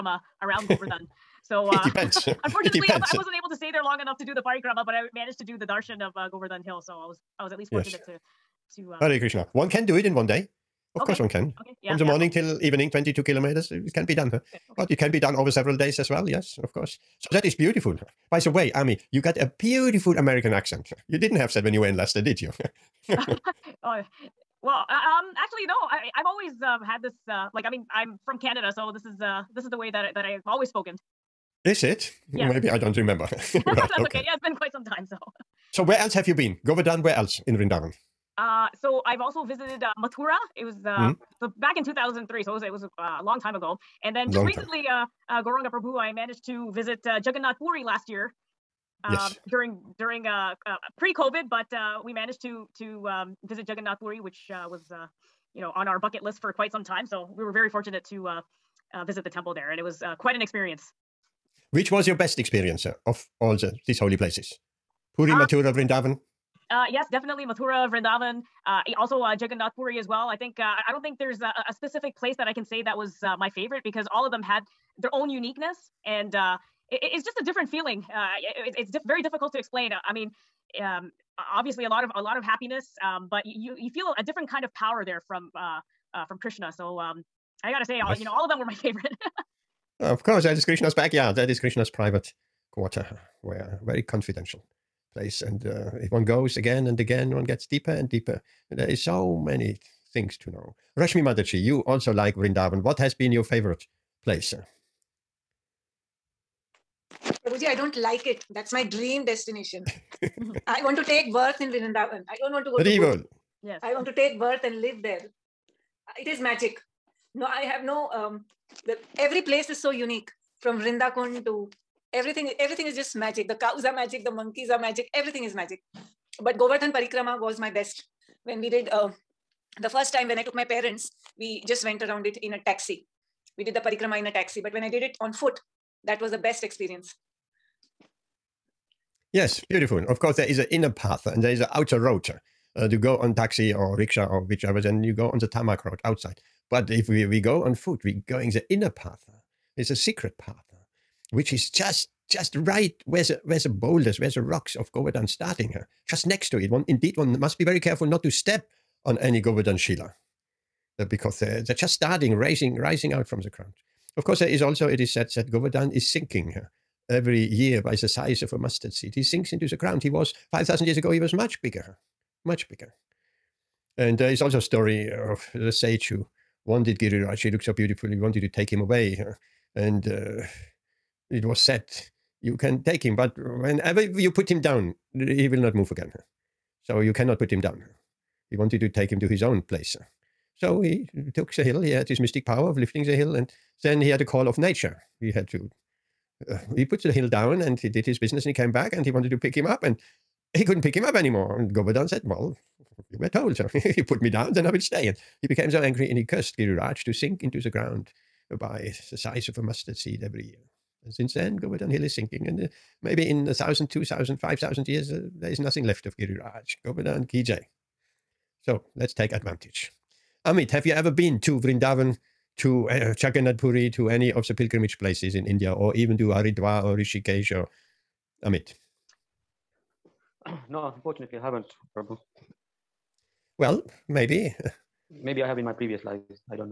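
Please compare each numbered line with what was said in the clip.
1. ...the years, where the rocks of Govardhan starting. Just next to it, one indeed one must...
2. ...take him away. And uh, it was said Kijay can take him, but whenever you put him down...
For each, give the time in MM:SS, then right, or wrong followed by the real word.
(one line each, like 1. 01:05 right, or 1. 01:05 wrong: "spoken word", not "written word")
1. 02:33 wrong: "boulders", not "years"
2. 02:58 wrong: "You", not "Kijay".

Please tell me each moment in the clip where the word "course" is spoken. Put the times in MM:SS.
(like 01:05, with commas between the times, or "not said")
00:11, 00:16, 01:30, 02:20, 02:44.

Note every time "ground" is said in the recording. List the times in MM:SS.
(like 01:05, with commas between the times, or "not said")
02:43, 02:49, 03:27.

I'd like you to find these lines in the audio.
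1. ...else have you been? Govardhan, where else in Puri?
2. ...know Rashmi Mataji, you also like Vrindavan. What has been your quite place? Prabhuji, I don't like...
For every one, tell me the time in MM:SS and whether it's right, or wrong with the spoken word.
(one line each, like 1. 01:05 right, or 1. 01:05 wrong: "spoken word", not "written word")
1. 00:35 wrong: "Vrindavan", not "Puri"
2. 01:40 wrong: "favorite", not "quite".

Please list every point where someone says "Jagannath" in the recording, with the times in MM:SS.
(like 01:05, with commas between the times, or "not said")
00:47, 00:53, 01:09, 03:43.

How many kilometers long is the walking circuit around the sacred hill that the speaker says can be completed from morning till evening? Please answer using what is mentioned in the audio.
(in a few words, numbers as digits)
22.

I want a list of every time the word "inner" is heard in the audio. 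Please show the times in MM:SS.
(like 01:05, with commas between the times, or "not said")
02:20, 02:28.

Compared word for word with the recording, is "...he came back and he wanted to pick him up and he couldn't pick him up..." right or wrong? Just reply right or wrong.
right.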